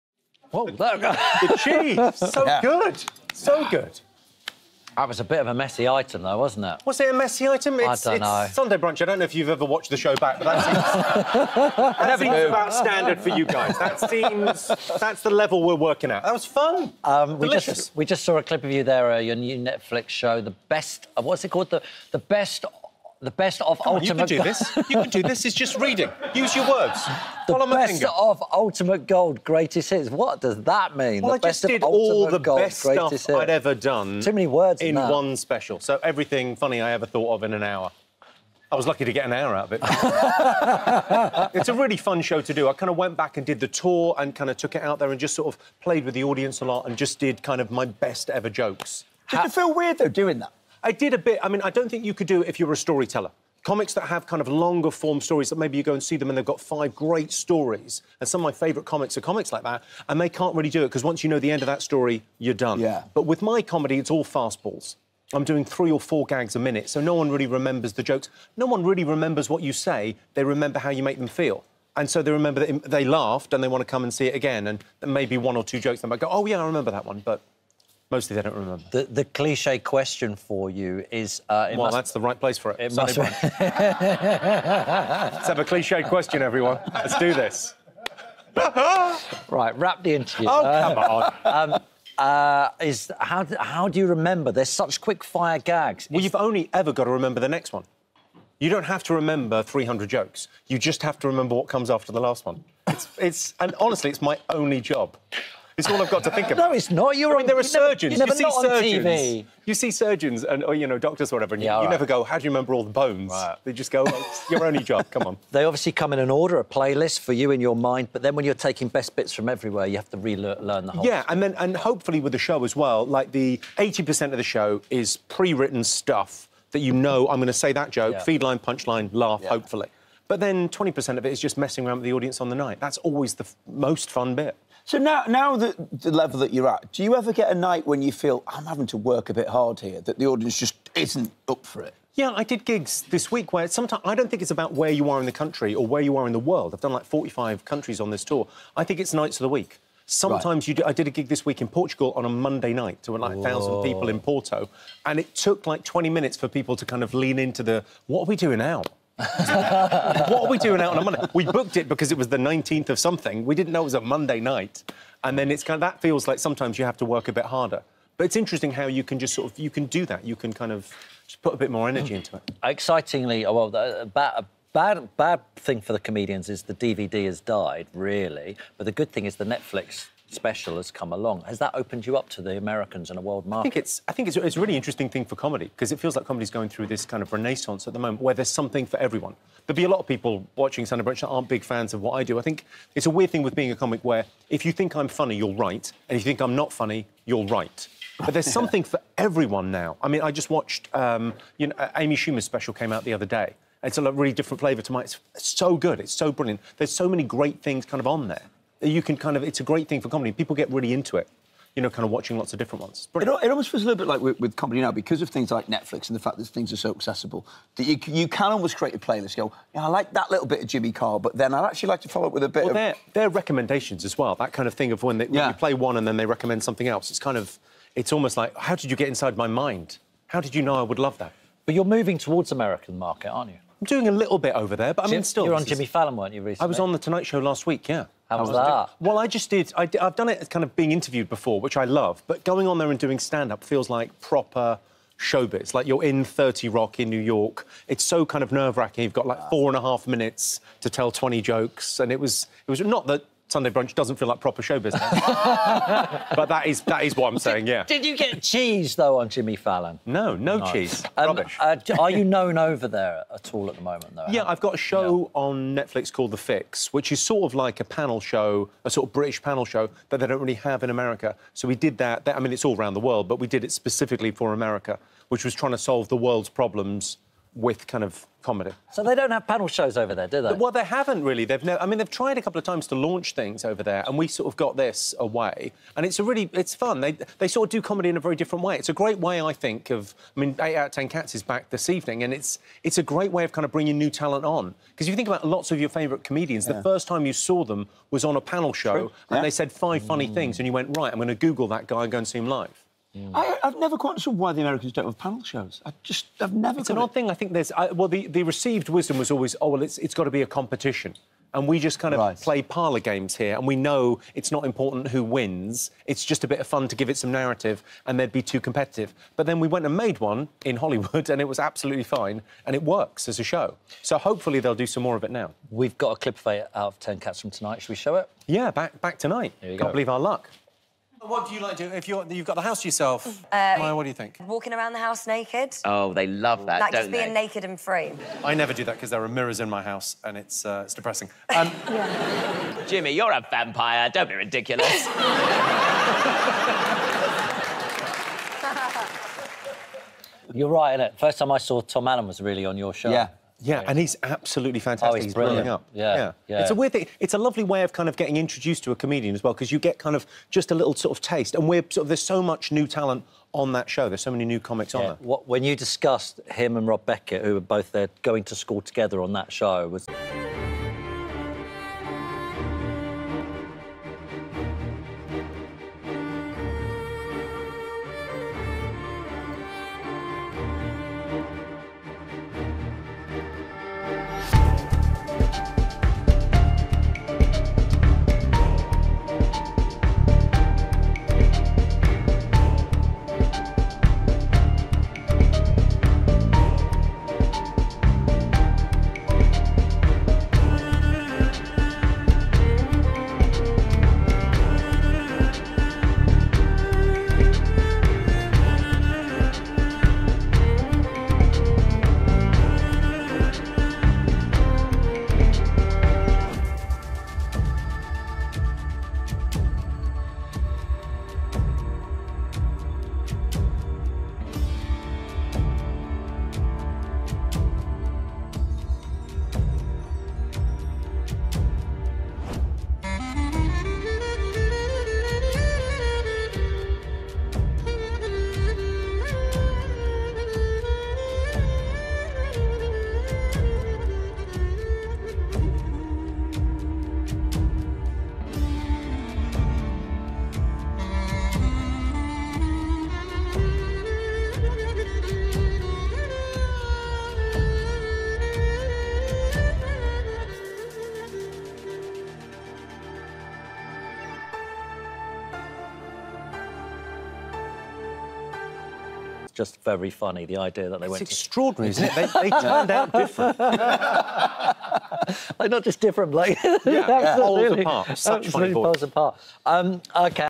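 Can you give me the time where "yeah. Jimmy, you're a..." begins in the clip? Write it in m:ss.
5:41.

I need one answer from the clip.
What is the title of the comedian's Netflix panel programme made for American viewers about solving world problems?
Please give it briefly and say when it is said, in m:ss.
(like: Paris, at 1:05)
The Fix, at 4:26.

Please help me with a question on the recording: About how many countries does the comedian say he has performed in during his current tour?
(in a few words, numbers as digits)
45.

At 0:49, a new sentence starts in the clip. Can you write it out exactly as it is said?
Did How- feel weird though doing that?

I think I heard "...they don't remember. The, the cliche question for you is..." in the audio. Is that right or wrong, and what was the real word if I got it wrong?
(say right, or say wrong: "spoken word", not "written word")
right.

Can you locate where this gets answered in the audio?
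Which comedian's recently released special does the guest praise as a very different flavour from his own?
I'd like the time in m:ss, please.
3:21.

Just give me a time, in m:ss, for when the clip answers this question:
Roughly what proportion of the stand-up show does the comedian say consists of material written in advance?
2:03.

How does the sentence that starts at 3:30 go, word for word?
People get really into it you know, kind of watching lots of different ones.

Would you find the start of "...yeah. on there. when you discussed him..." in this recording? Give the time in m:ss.
6:04.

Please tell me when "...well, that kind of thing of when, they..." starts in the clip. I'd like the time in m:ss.
3:44.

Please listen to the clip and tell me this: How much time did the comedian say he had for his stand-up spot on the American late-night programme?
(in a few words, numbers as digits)
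Four and a half minutes.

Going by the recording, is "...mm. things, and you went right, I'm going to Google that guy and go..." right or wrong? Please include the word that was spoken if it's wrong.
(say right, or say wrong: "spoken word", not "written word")
right.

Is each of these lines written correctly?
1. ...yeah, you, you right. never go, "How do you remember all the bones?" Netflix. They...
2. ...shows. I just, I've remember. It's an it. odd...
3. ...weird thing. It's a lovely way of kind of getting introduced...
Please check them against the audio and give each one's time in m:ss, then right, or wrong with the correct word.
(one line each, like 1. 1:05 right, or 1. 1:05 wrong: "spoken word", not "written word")
1. 1:51 wrong: "Right", not "Netflix"
2. 5:05 wrong: "never", not "remember"
3. 5:56 right.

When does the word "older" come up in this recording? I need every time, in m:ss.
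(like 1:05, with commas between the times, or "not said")
not said.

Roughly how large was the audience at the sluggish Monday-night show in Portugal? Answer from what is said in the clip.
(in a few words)
A thousand.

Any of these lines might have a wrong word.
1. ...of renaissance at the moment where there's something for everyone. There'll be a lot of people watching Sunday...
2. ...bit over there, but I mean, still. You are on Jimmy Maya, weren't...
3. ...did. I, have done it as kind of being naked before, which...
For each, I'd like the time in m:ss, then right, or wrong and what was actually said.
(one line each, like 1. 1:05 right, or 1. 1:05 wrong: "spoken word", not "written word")
1. 3:07 right
2. 3:54 wrong: "Fallon", not "Maya"
3. 3:59 wrong: "interviewed", not "naked".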